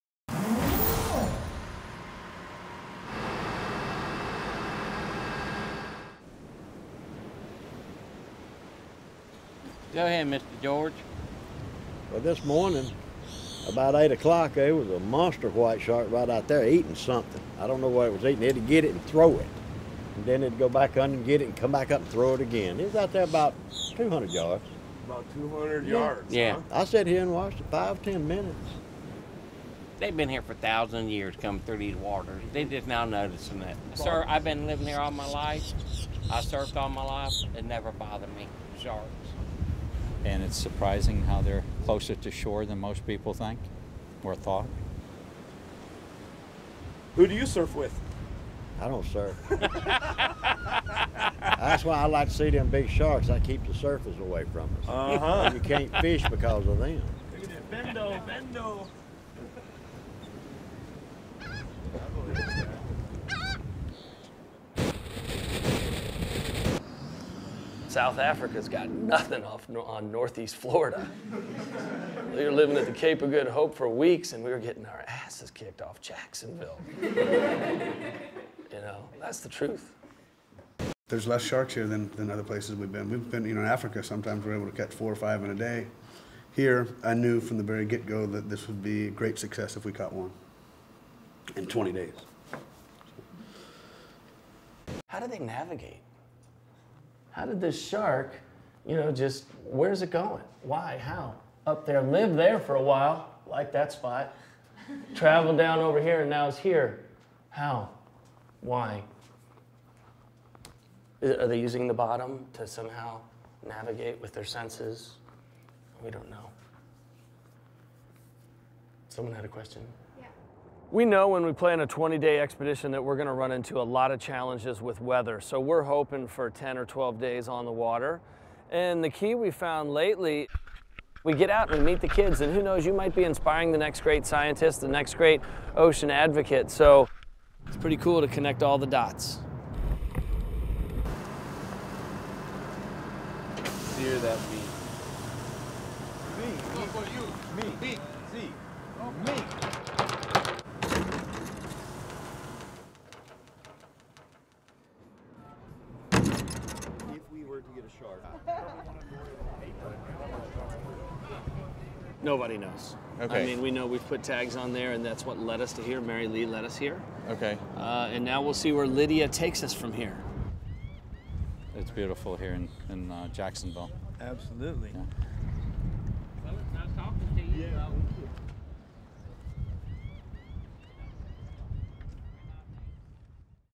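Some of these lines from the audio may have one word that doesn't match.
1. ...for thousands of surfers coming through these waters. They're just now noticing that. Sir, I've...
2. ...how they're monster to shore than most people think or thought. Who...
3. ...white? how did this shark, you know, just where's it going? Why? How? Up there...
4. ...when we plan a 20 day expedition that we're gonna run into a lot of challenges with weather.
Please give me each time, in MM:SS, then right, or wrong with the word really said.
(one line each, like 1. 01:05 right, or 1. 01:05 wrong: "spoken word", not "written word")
1. 00:30 wrong: "years", not "surfers"
2. 00:41 wrong: "closer", not "monster"
3. 01:35 wrong: "navigate", not "white"
4. 02:01 right.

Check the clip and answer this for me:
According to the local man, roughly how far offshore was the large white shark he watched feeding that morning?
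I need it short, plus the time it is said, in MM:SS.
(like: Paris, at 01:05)
200 yards, at 00:23.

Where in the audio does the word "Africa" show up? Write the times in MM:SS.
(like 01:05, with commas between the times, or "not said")
01:08, 01:23.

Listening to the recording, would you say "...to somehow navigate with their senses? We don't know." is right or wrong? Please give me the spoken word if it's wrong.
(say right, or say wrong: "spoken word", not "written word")
right.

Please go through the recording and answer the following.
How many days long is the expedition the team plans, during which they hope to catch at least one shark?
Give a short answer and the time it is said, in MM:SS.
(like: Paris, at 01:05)
20, at 01:31.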